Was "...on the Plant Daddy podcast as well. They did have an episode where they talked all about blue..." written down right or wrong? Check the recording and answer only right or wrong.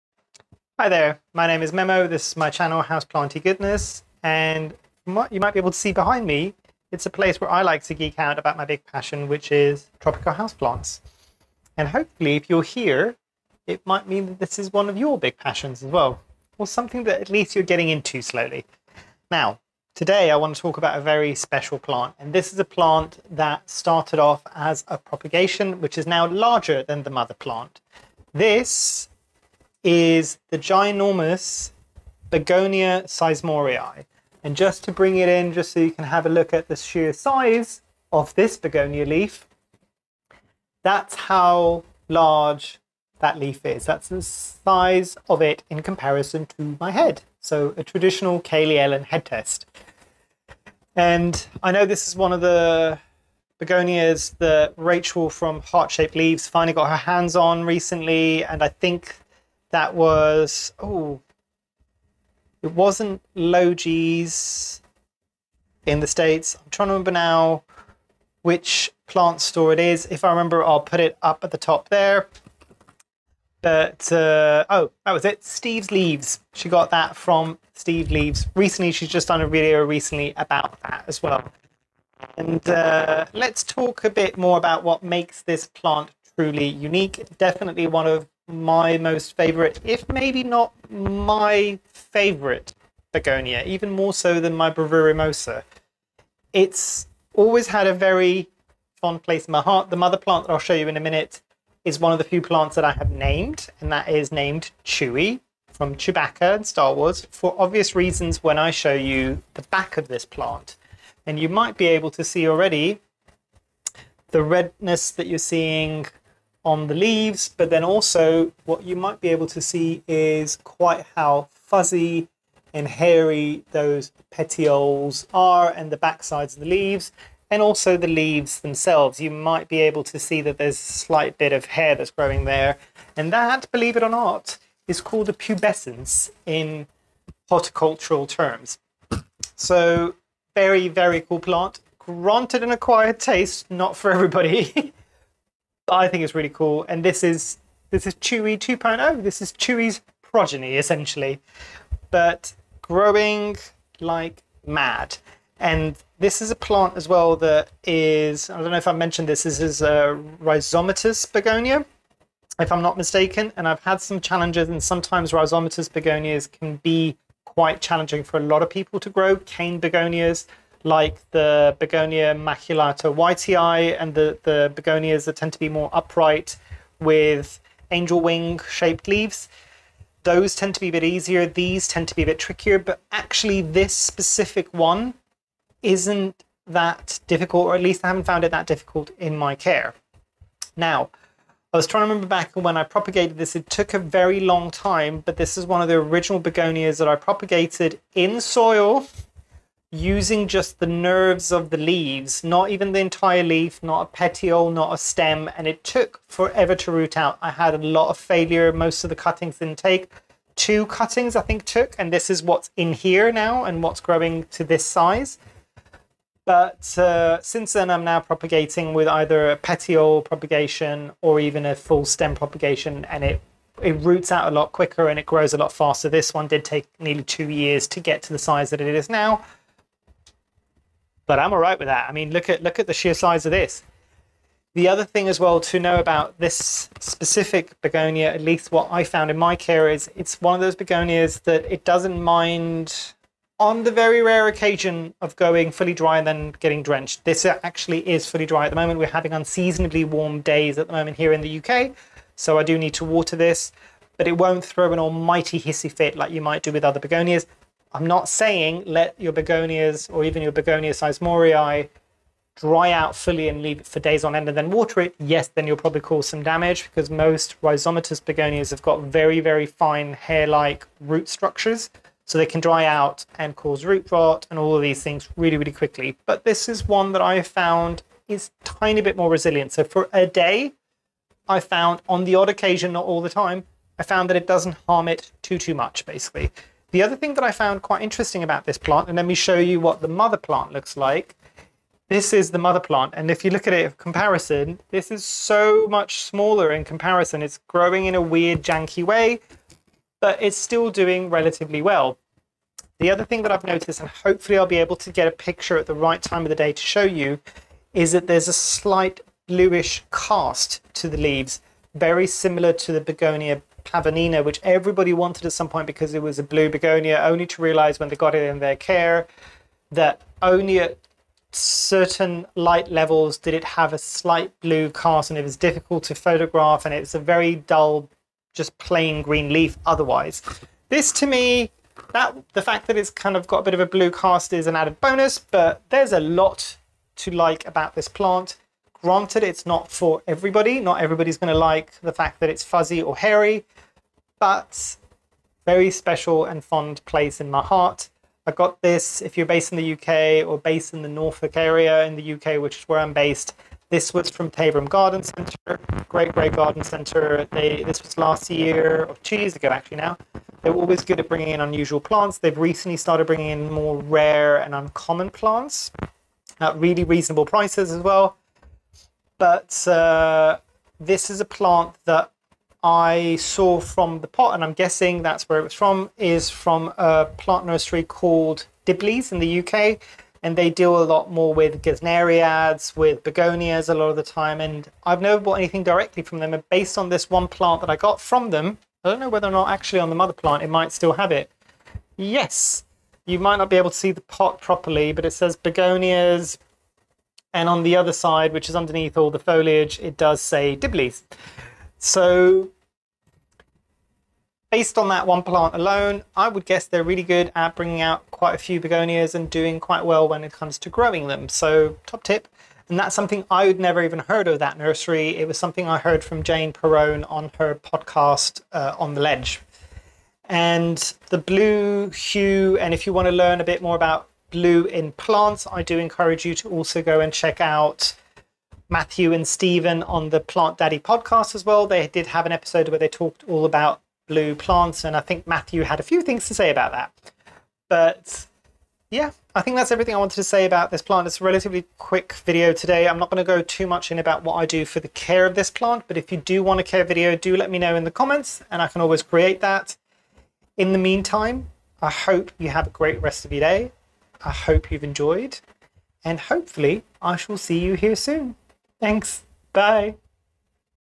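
right.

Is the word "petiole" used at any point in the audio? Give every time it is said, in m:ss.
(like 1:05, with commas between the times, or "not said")
2:04, 3:24, 3:39.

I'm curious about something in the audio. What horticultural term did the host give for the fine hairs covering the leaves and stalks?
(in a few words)
pubescence.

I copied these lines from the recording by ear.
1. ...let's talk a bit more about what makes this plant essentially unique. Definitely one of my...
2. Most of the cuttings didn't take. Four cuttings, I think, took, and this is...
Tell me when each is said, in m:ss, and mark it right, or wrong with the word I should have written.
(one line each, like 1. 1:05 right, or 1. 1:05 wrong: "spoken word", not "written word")
1. 1:23 wrong: "truly", not "essentially"
2. 3:28 wrong: "Two", not "Four".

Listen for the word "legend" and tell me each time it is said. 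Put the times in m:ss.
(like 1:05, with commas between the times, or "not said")
not said.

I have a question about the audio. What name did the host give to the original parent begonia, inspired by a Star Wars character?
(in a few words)
Chewie.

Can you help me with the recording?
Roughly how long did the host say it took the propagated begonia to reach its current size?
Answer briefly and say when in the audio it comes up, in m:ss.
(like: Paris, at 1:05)
nearly 2 years, at 3:46.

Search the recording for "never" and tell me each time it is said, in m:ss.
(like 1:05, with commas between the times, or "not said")
6:25, 6:53.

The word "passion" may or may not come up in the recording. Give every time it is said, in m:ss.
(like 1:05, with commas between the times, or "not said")
0:08, 0:15.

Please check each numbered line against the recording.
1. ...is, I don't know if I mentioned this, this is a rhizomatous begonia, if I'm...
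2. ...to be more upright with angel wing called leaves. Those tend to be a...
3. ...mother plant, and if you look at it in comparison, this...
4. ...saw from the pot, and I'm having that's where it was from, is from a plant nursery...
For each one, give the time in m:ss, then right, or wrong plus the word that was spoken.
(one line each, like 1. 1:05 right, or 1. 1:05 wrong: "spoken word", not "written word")
1. 2:37 right
2. 2:55 wrong: "shaped", not "called"
3. 4:52 right
4. 6:13 wrong: "guessing", not "having".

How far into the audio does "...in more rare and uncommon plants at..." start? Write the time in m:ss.
6:03.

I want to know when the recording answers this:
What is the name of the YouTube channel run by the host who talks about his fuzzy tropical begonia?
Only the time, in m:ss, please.
0:02.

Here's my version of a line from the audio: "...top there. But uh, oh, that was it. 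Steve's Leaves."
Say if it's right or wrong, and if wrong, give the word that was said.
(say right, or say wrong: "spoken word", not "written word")
right.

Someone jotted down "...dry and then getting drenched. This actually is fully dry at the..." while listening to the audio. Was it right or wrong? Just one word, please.
right.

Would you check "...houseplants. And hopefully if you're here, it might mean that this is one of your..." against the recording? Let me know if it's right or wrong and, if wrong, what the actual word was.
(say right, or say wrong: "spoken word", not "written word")
right.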